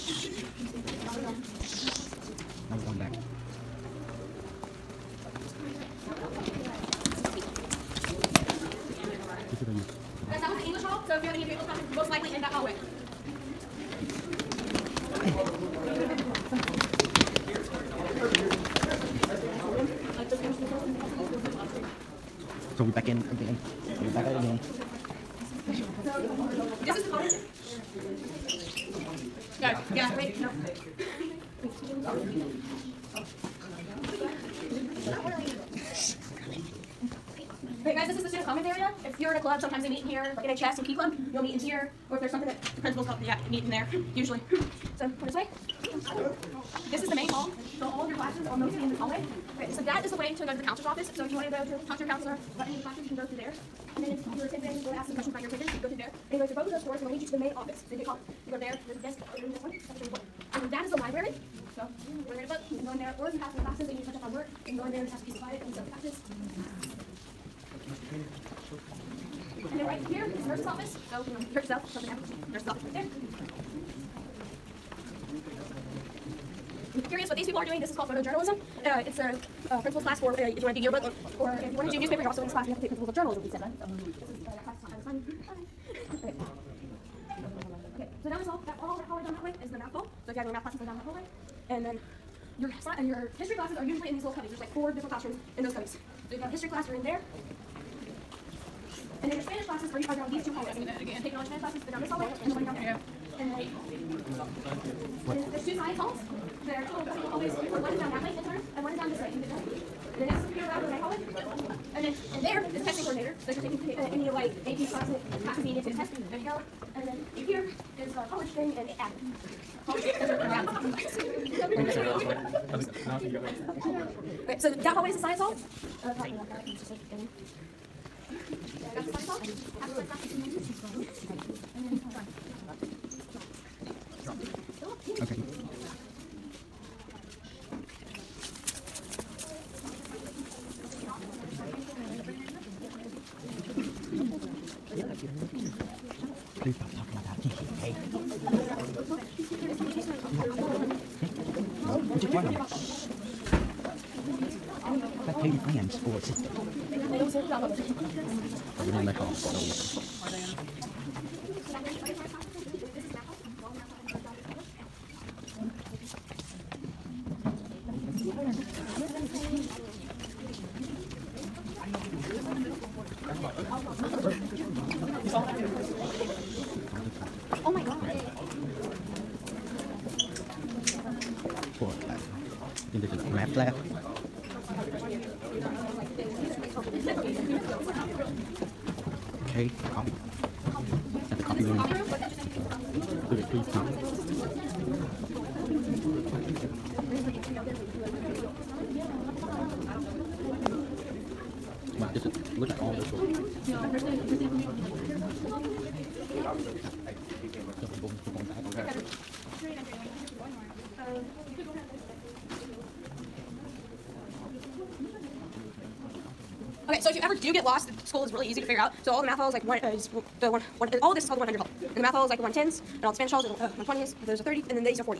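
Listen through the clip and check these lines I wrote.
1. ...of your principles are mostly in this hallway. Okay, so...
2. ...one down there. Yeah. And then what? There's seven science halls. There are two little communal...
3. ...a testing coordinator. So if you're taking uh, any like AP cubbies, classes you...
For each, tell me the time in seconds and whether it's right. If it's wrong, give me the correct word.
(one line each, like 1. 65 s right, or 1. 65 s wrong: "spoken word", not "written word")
1. 48 s wrong: "classes", not "principles"
2. 102 s wrong: "two", not "seven"
3. 112 s wrong: "classes", not "cubbies".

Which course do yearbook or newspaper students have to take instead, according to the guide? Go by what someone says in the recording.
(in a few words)
principles of journalism.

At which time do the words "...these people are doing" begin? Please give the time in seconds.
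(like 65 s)
77 s.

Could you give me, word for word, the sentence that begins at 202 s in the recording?
just look at all those tools.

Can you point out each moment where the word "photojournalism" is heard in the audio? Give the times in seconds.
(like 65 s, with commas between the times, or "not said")
78 s.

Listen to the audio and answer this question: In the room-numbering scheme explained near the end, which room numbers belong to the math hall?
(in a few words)
110s.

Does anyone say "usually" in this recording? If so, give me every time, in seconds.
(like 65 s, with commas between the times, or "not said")
44 s, 93 s.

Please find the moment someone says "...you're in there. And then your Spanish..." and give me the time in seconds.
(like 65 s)
96 s.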